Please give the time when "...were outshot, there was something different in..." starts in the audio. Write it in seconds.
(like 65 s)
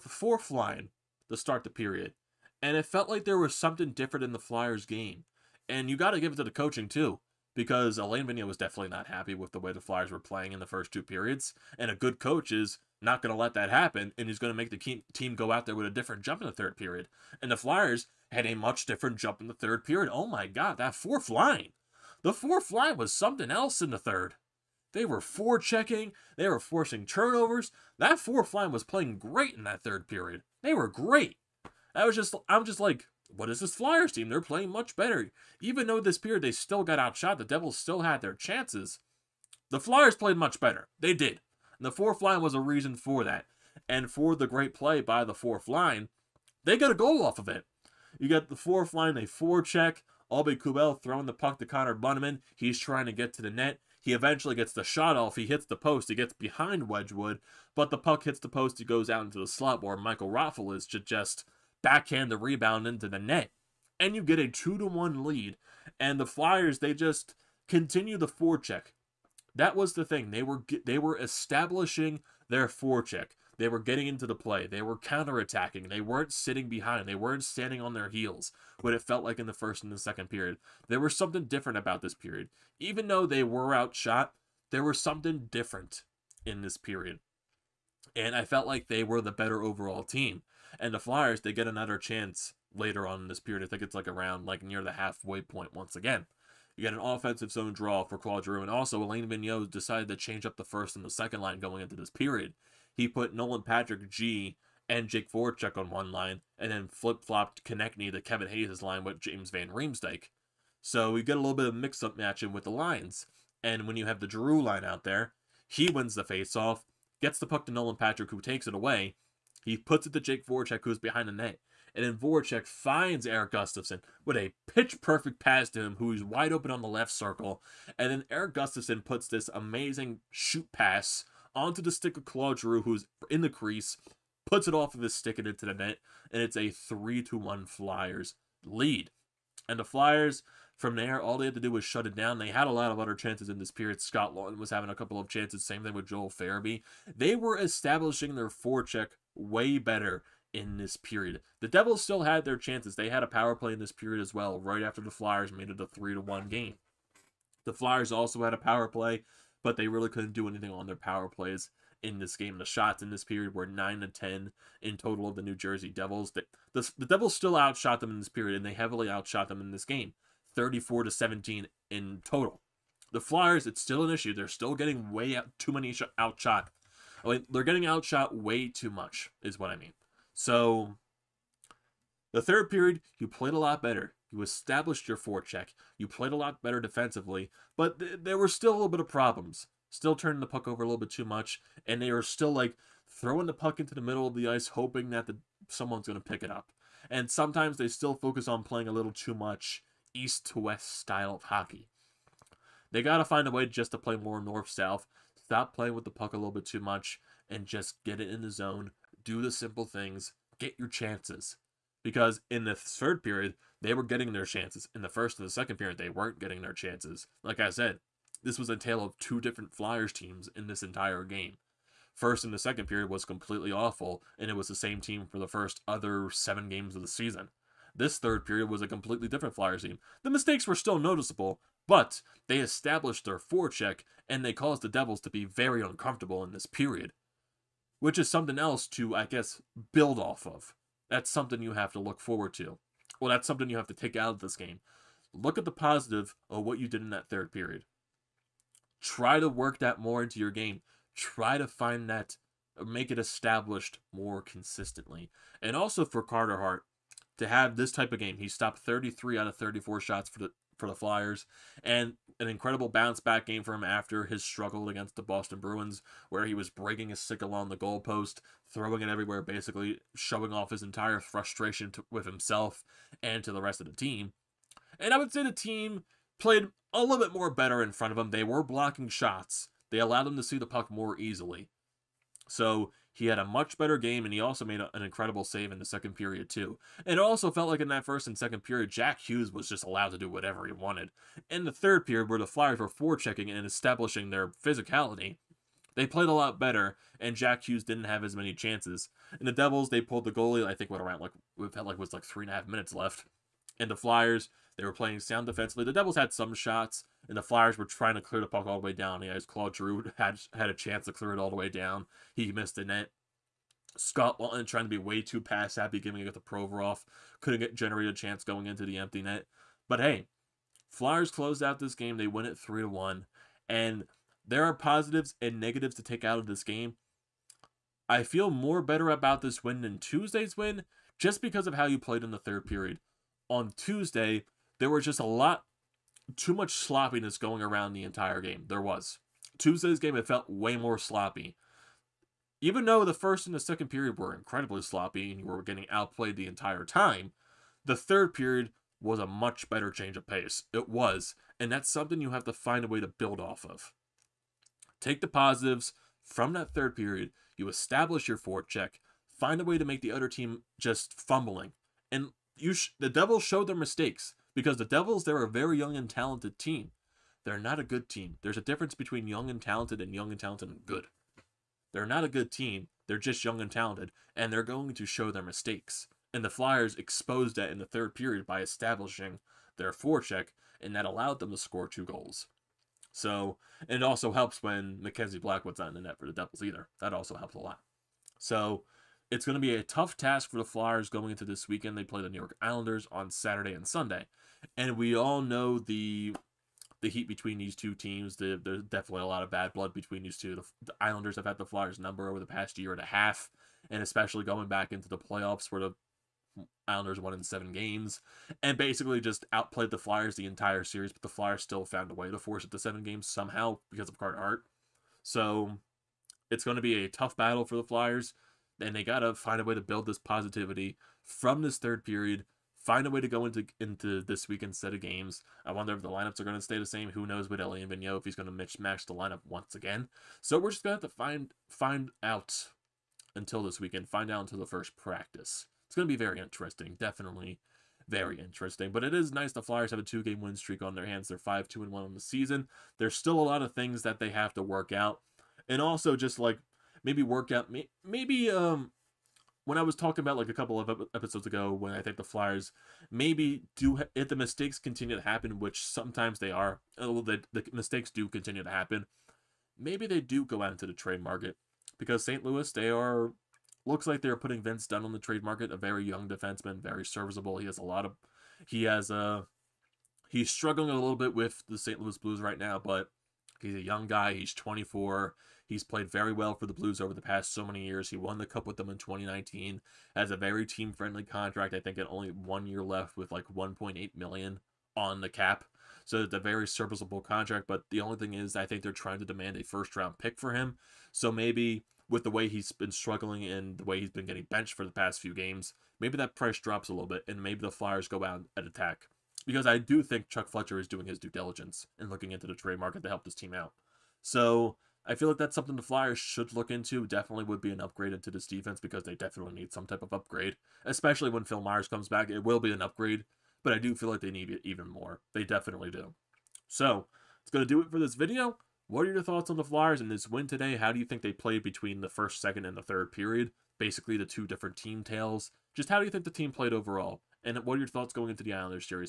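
83 s.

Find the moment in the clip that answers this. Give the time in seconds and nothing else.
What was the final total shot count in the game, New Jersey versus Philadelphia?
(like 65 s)
170 s.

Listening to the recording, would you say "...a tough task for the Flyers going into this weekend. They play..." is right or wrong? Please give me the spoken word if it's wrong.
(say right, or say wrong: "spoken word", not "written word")
right.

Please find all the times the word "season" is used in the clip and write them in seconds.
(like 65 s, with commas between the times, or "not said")
227 s, 442 s.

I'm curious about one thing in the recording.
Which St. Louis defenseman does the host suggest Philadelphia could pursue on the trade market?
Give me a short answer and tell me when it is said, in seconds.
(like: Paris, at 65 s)
Vince Dunn, at 464 s.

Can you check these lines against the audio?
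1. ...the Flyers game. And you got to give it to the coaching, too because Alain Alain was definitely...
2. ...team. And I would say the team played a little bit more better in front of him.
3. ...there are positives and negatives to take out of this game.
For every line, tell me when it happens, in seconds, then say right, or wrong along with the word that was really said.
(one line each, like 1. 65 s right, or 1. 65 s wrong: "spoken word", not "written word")
1. 4 s wrong: "Vigneault", not "Alain"
2. 273 s right
3. 324 s right.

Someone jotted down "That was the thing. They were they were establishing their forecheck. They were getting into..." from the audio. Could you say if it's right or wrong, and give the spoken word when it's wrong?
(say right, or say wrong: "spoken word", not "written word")
right.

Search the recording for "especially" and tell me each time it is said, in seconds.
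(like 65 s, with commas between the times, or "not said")
404 s, 510 s.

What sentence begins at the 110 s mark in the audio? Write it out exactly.
So we get a little bit of mix-up matching with the lines.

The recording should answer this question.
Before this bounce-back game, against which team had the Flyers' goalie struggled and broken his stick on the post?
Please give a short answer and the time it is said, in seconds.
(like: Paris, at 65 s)
Boston Bruins, at 265 s.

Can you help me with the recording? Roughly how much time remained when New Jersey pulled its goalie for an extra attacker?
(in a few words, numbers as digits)
three and a half minutes.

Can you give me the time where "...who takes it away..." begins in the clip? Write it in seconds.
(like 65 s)
118 s.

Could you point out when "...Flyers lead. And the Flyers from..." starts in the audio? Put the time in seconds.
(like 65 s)
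137 s.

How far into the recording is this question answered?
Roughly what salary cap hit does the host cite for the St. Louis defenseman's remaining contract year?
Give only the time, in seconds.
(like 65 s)
483 s.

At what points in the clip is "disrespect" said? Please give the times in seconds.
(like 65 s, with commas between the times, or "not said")
not said.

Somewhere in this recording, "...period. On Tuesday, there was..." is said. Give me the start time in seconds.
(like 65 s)
332 s.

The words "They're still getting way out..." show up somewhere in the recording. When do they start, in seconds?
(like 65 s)
174 s.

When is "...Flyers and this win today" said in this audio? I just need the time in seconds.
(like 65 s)
519 s.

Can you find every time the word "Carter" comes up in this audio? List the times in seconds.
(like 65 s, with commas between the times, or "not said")
256 s, 414 s.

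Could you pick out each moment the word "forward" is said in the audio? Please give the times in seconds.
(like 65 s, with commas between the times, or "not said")
242 s, 358 s.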